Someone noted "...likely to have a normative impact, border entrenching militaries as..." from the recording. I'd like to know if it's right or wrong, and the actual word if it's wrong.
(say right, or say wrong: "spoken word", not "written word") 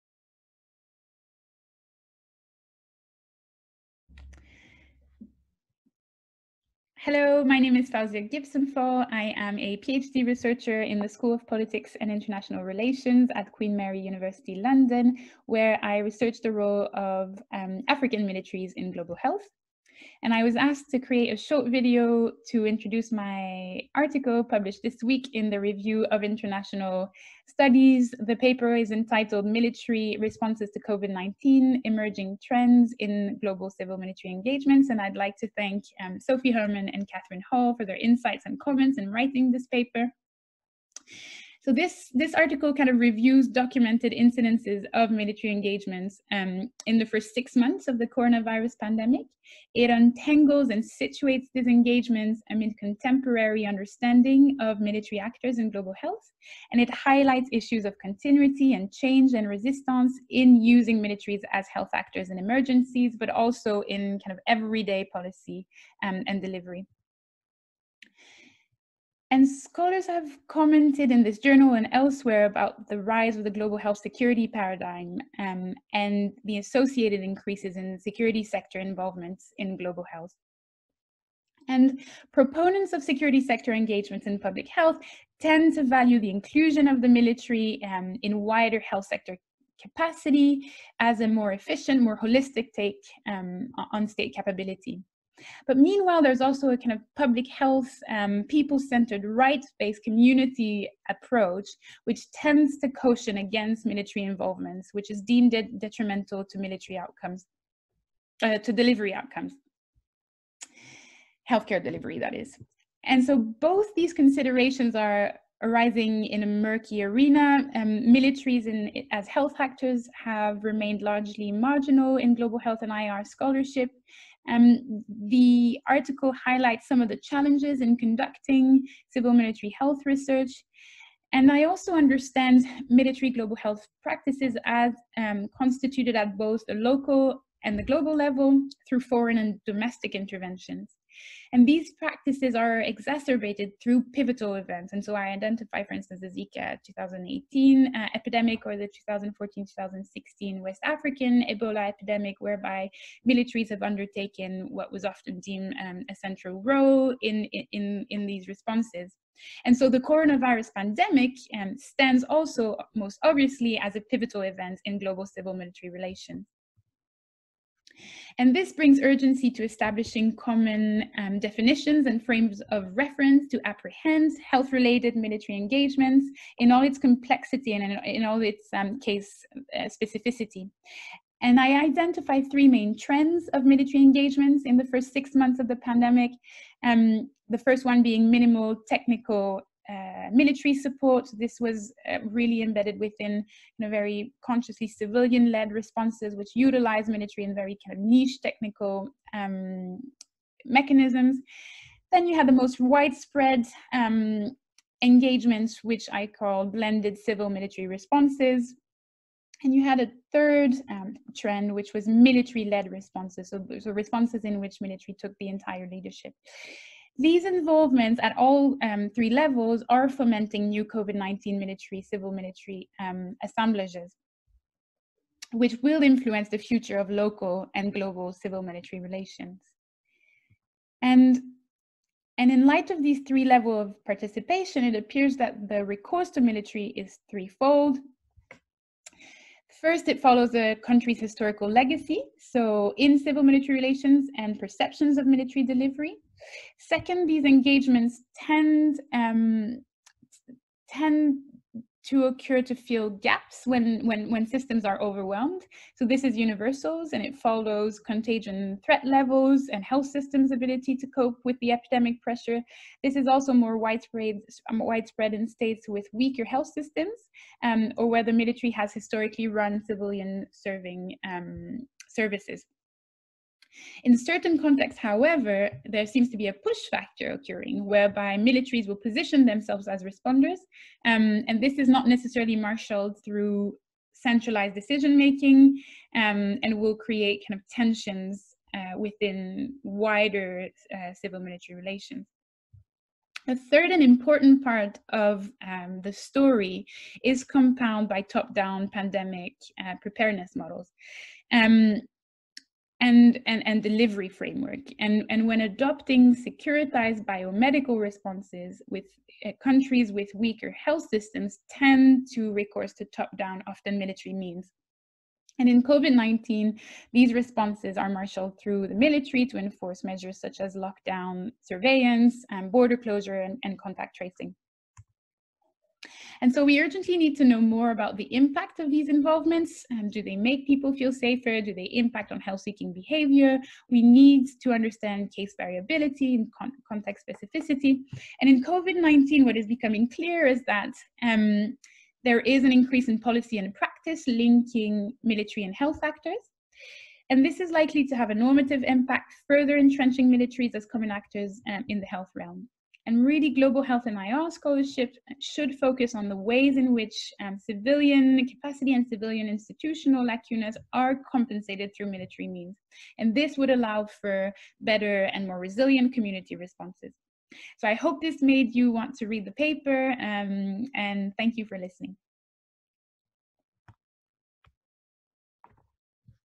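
wrong: "further", not "border".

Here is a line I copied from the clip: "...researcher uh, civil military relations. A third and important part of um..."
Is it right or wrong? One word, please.
wrong.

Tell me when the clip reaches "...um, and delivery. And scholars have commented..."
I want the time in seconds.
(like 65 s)
66 s.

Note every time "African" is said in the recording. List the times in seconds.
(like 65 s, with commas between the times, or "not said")
17 s, 150 s.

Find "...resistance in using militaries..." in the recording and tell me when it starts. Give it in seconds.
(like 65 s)
59 s.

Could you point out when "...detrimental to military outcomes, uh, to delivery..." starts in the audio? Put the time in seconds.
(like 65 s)
105 s.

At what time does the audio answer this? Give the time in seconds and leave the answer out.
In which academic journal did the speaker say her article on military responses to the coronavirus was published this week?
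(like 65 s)
25 s.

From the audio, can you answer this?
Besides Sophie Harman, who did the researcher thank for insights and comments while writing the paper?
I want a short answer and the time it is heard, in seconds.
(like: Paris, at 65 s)
Catherine Hall, at 37 s.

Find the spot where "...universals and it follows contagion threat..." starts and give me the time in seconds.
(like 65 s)
256 s.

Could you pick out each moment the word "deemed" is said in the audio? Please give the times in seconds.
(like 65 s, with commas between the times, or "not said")
105 s, 155 s.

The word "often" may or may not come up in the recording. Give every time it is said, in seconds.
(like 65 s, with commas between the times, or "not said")
155 s, 313 s.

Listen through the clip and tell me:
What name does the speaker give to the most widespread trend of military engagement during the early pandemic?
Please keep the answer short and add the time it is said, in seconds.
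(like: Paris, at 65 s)
blended civil military responses, at 206 s.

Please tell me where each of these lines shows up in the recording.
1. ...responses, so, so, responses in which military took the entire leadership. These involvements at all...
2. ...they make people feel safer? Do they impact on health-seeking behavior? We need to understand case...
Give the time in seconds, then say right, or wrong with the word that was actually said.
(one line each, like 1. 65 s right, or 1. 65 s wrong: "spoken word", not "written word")
1. 212 s right
2. 330 s right.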